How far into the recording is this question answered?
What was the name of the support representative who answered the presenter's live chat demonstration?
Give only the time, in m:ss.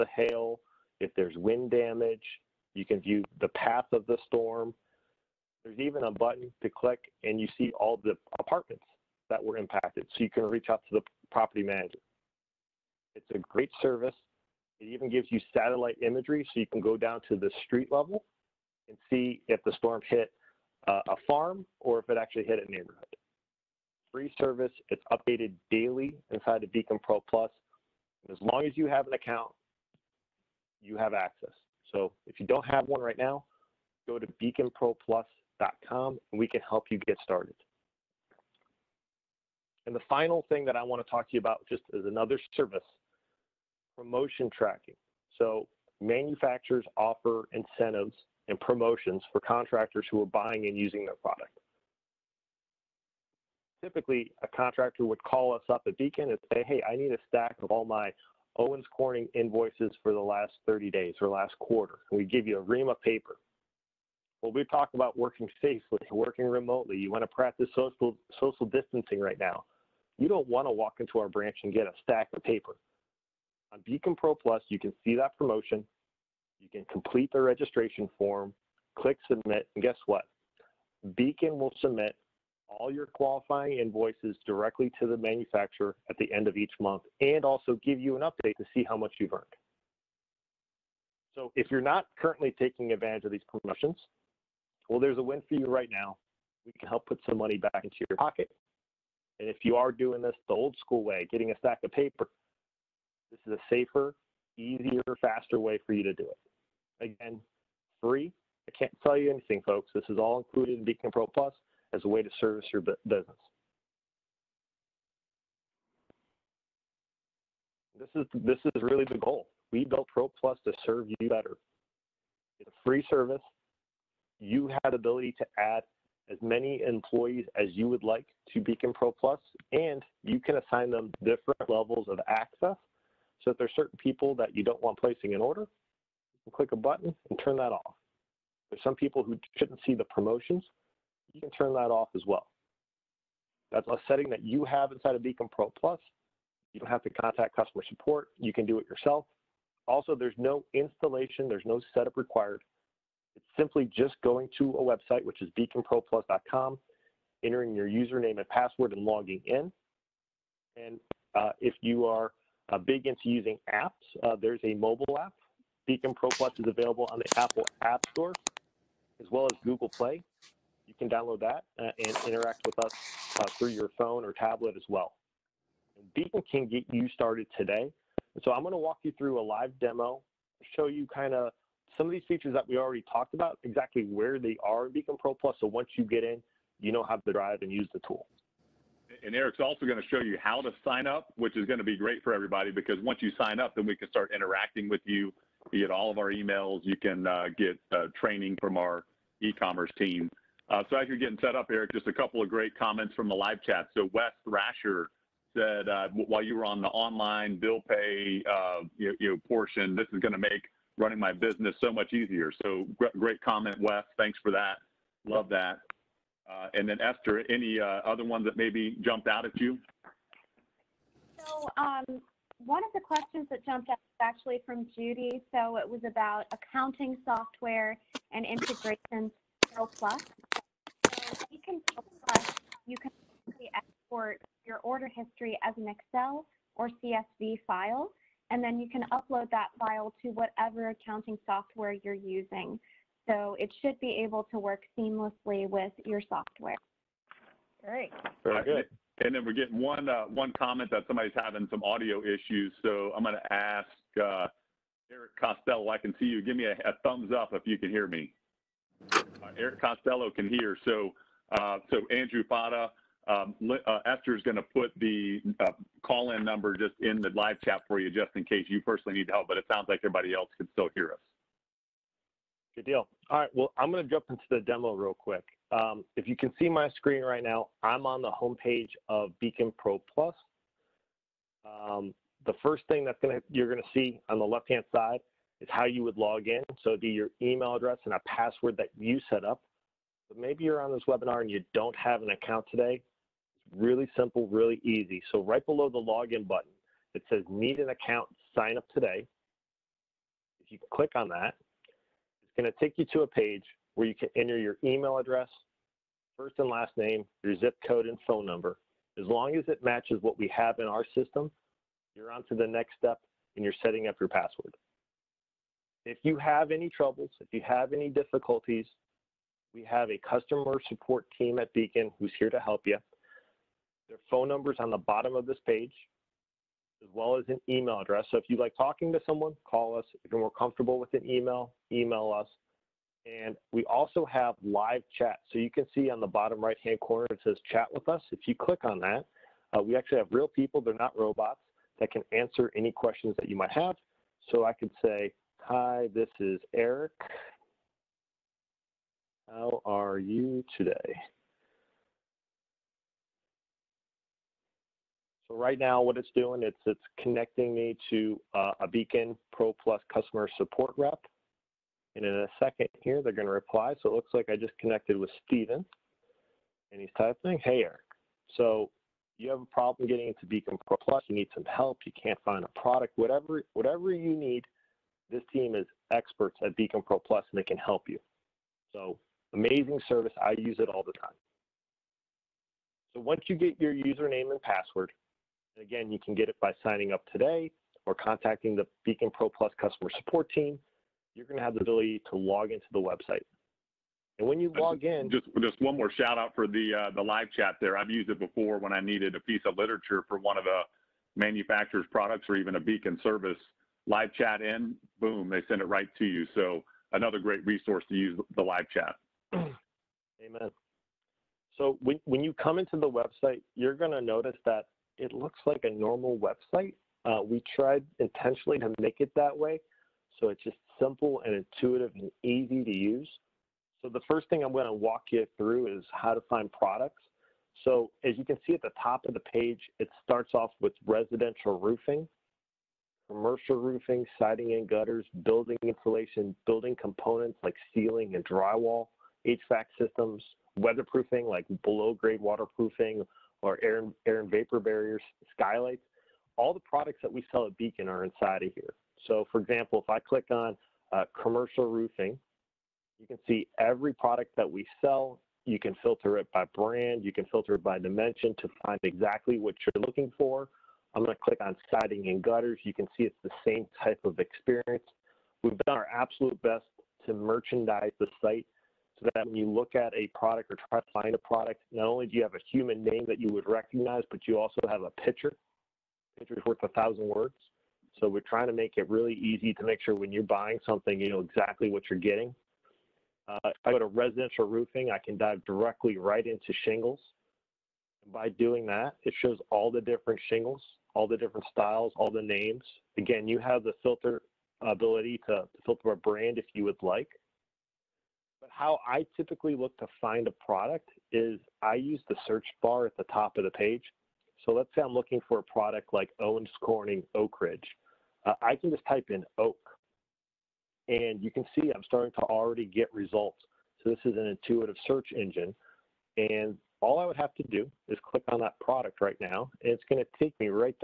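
6:05.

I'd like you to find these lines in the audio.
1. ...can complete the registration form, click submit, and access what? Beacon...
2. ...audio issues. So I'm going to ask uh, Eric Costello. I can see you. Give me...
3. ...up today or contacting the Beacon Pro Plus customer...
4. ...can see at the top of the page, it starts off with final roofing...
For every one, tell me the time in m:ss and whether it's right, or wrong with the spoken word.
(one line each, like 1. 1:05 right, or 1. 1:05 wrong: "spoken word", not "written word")
1. 1:16 wrong: "guess", not "access"
2. 4:11 right
3. 6:27 right
4. 7:08 wrong: "residential", not "final".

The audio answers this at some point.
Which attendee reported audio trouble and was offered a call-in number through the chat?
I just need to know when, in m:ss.
4:22.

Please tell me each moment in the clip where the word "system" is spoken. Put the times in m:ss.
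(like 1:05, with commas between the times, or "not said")
5:11, 7:19.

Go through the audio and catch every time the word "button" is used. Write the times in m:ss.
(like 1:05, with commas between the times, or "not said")
0:06, 2:16, 4:56.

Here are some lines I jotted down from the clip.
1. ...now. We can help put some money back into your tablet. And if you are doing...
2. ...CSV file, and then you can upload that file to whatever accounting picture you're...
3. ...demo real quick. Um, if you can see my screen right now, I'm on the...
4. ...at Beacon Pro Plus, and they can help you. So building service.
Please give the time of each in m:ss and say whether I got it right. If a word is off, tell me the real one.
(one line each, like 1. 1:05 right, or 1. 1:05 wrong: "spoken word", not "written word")
1. 1:35 wrong: "pocket", not "tablet"
2. 3:57 wrong: "software", not "picture"
3. 4:34 right
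4. 6:16 wrong: "amazing", not "building".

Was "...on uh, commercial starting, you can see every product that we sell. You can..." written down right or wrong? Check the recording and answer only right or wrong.
wrong.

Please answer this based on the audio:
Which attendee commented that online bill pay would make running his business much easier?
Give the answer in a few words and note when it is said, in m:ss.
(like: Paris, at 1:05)
Wes Thrasher, at 3:24.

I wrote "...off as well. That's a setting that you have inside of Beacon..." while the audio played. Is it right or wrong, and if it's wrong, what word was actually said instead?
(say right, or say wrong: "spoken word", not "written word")
right.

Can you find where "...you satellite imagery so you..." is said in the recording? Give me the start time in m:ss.
0:15.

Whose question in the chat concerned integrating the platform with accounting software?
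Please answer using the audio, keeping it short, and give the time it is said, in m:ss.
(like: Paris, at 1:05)
Judy, at 3:44.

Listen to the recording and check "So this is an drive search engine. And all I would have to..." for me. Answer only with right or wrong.
wrong.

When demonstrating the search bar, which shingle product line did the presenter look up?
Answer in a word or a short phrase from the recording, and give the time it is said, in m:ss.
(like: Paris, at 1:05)
Oak Ridge, at 8:27.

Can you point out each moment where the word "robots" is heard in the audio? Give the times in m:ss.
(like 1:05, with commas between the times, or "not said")
5:41.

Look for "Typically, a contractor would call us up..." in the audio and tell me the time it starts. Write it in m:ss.
0:53.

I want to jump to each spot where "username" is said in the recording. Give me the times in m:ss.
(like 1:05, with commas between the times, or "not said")
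2:37, 6:23.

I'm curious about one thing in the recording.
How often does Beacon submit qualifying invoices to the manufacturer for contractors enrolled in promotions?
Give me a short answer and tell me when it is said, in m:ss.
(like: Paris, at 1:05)
at the end of each month, at 1:26.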